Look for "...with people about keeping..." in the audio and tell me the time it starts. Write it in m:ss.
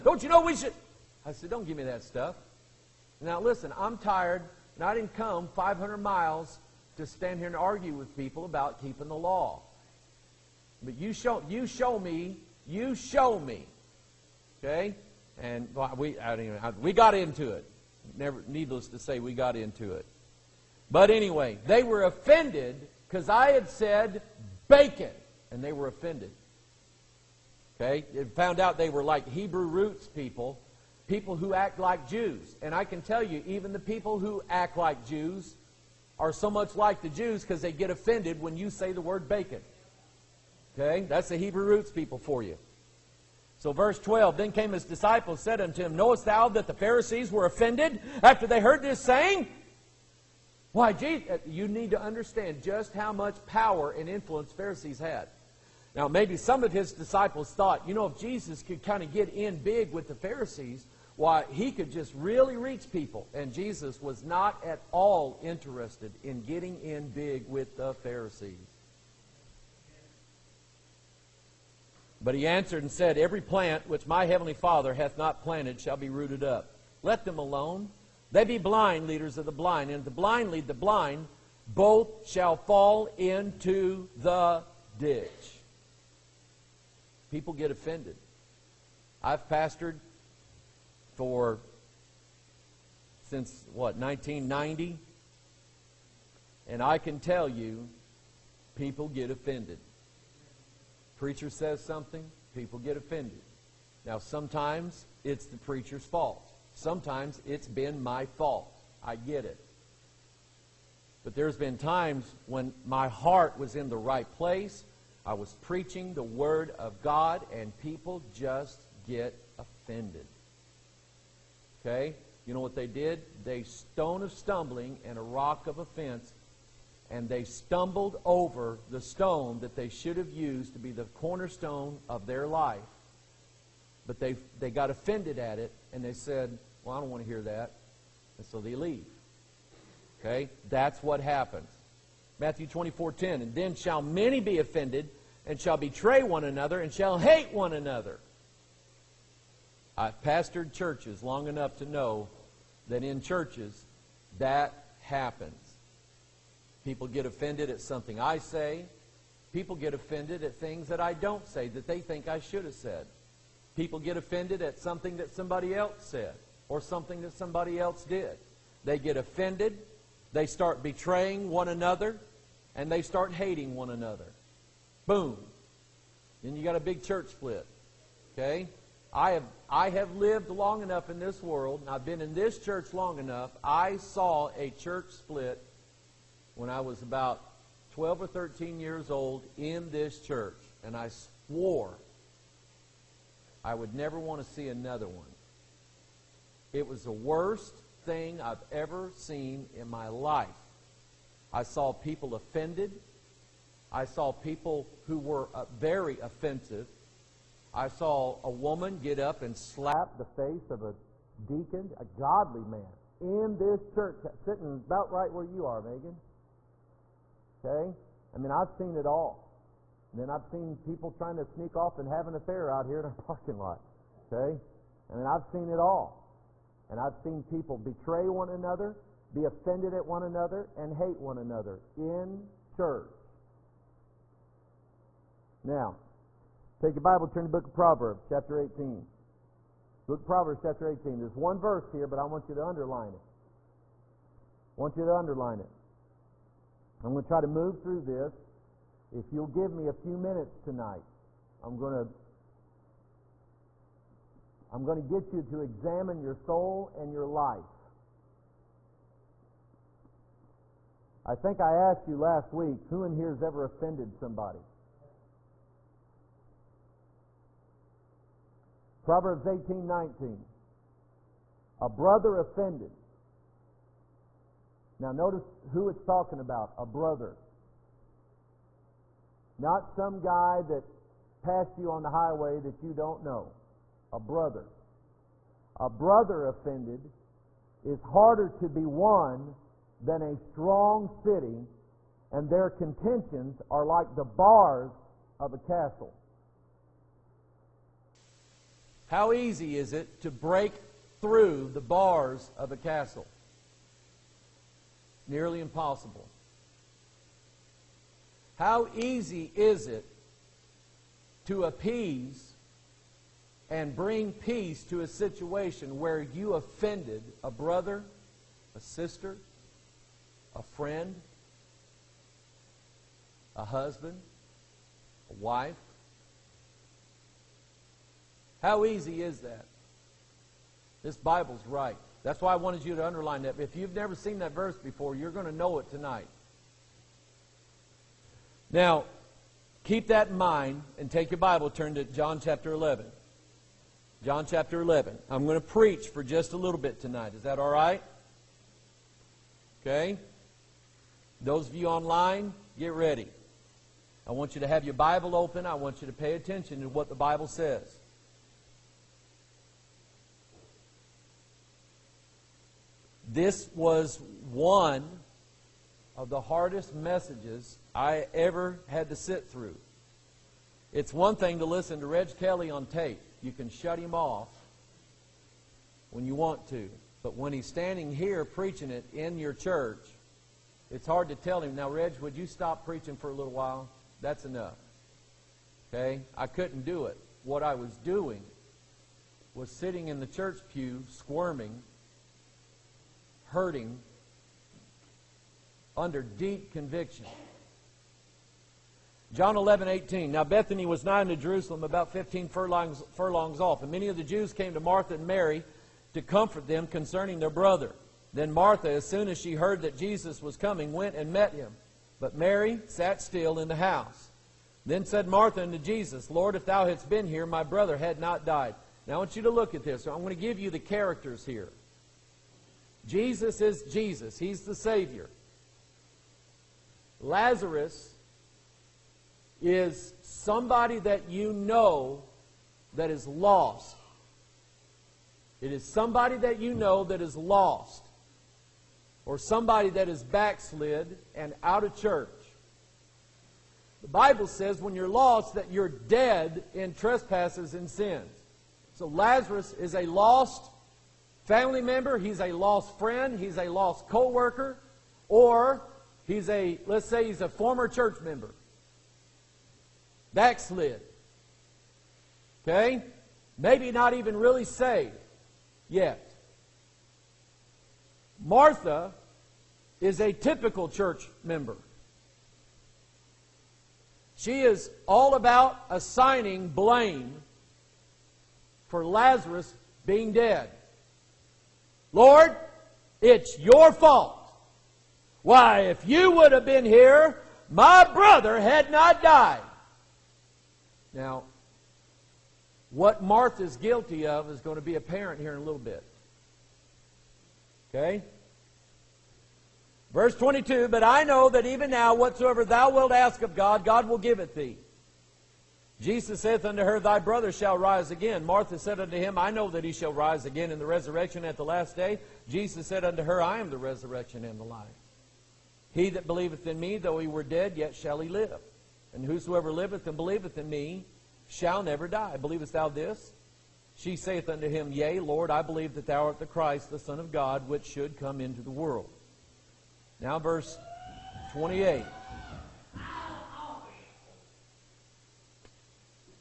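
0:07.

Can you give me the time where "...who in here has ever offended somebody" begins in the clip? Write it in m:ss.
4:22.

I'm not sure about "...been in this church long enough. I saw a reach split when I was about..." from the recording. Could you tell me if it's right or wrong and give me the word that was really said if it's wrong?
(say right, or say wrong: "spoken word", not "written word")
wrong: "church", not "reach".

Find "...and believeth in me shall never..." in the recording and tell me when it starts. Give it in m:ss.
8:40.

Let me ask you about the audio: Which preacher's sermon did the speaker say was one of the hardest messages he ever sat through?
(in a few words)
Reg Kelly.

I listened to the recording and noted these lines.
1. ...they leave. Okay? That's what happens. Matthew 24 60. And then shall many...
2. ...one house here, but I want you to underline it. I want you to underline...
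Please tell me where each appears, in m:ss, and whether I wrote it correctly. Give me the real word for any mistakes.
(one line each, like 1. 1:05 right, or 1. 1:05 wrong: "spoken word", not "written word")
1. 2:18 wrong: "10", not "60"
2. 4:01 wrong: "verse", not "house".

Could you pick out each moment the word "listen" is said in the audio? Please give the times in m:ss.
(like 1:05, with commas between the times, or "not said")
0:03, 6:11.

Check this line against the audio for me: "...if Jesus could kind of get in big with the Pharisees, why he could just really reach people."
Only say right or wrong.
right.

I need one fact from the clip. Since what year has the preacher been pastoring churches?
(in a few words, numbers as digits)
1990.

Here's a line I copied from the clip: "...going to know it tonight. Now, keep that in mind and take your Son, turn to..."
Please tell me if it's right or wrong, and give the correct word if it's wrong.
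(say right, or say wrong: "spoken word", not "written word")
wrong: "Bible", not "Son".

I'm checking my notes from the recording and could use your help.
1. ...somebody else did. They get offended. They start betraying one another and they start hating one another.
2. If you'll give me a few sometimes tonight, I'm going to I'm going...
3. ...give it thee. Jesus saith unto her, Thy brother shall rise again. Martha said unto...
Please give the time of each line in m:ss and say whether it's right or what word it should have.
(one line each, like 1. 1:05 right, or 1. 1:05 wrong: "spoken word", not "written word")
1. 2:47 right
2. 4:09 wrong: "minutes", not "sometimes"
3. 8:24 right.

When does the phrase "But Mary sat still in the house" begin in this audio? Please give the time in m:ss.
6:52.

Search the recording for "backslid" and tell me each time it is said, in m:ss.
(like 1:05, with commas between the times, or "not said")
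7:20, 7:40.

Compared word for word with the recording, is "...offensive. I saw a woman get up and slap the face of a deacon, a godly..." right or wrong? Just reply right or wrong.
right.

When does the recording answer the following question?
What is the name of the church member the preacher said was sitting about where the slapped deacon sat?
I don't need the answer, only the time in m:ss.
3:35.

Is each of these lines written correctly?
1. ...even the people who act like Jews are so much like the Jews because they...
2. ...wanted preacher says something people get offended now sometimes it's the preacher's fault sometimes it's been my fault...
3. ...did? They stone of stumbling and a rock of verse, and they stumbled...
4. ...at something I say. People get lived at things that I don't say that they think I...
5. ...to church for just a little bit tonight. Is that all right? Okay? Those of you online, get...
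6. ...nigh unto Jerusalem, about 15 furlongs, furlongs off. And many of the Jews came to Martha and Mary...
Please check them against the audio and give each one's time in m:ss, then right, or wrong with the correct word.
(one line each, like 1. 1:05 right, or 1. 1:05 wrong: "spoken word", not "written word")
1. 0:33 right
2. 1:39 wrong: "offended", not "wanted"
3. 2:02 wrong: "offense", not "verse"
4. 2:37 wrong: "offended", not "lived"
5. 5:45 wrong: "preach", not "church"
6. 6:41 right.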